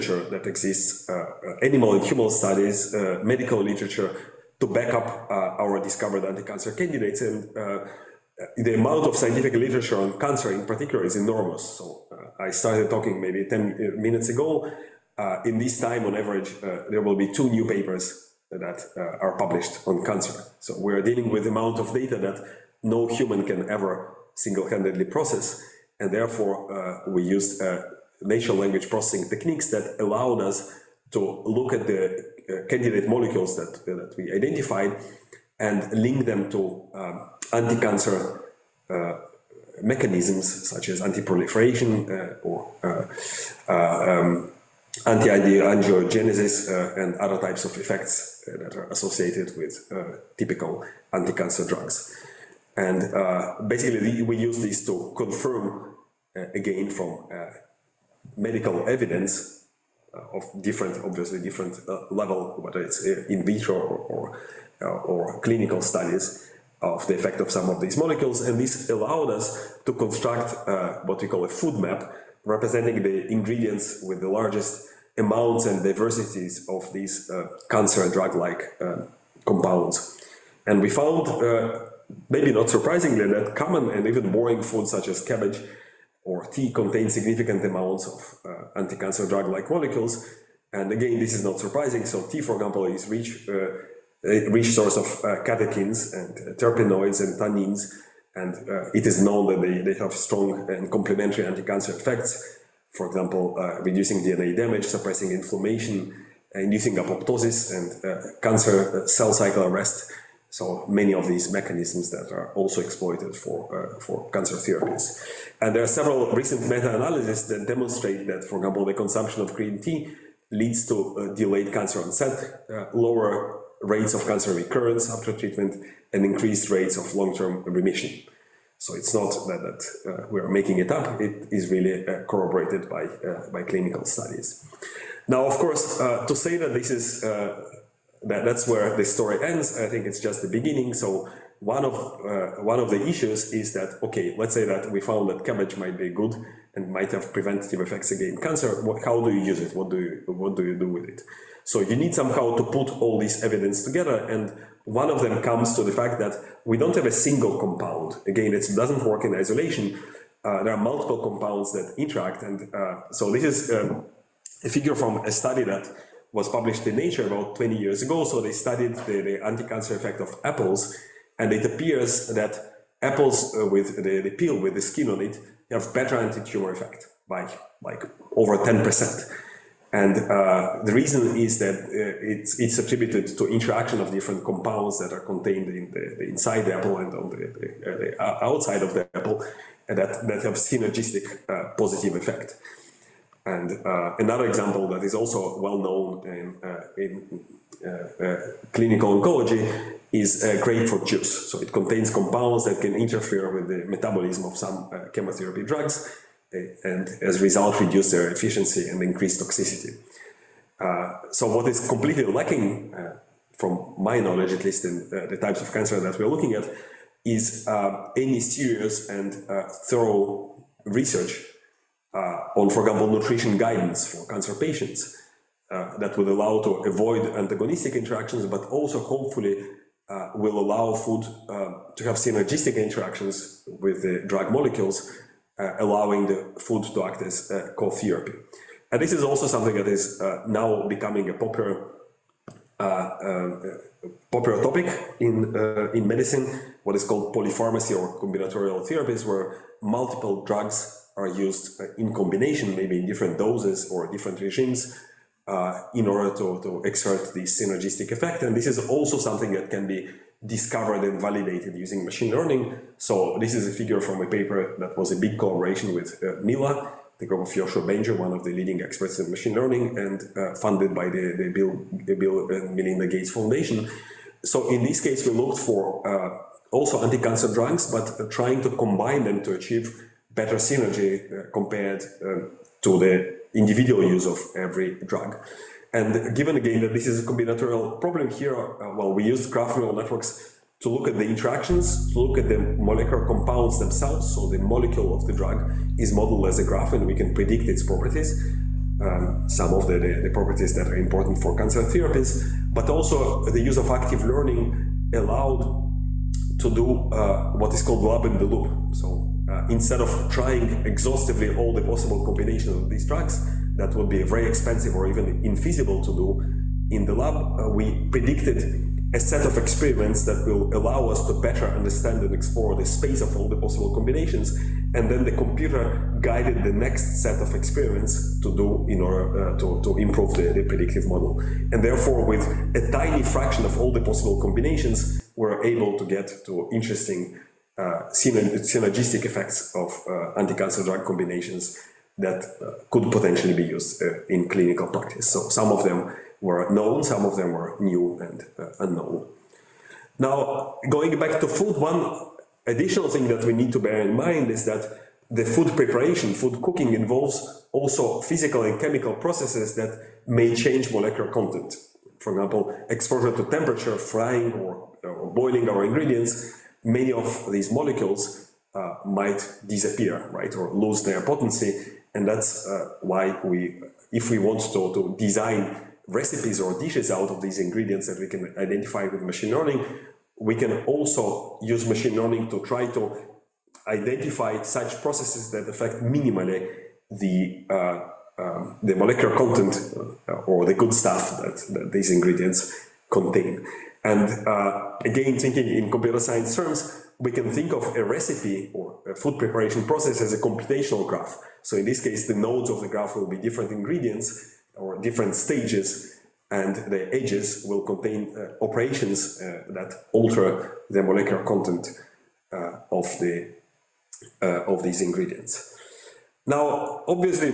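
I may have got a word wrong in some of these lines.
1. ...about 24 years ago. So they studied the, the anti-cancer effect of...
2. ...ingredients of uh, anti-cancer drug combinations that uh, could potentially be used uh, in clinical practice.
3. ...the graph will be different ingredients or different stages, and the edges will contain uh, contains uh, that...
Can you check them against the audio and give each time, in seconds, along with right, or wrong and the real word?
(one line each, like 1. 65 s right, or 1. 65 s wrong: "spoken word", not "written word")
1. 167 s wrong: "20", not "24"
2. 339 s wrong: "effects", not "ingredients"
3. 402 s wrong: "operations", not "contains".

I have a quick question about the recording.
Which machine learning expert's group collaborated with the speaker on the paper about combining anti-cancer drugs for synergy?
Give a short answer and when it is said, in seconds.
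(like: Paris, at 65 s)
Yoshua Bengio, at 267 s.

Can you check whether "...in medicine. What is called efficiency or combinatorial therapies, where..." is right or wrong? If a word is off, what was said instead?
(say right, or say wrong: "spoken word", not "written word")
wrong: "polypharmacy", not "efficiency".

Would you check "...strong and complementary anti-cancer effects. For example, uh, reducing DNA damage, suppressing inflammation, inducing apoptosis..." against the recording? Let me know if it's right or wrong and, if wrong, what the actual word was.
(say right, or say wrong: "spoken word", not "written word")
right.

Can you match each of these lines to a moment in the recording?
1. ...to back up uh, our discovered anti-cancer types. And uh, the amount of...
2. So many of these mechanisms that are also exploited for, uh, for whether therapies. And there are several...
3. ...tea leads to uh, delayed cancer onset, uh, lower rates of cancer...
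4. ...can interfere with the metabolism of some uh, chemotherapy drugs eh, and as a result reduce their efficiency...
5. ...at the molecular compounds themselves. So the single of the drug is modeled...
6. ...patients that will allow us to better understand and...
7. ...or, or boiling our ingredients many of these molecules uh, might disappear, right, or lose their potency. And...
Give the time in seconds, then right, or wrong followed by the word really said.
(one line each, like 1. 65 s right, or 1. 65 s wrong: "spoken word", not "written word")
1. 4 s wrong: "candidates", not "types"
2. 110 s wrong: "cancer", not "whether"
3. 119 s right
4. 202 s right
5. 292 s wrong: "molecule", not "single"
6. 319 s wrong: "experiments", not "patients"
7. 364 s right.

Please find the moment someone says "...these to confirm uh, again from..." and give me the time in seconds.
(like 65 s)
54 s.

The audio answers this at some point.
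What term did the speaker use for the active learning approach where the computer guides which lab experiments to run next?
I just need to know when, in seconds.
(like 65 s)
308 s.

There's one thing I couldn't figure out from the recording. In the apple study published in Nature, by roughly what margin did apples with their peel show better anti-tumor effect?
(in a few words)
over 10%.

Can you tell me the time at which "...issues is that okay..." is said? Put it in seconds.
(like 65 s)
143 s.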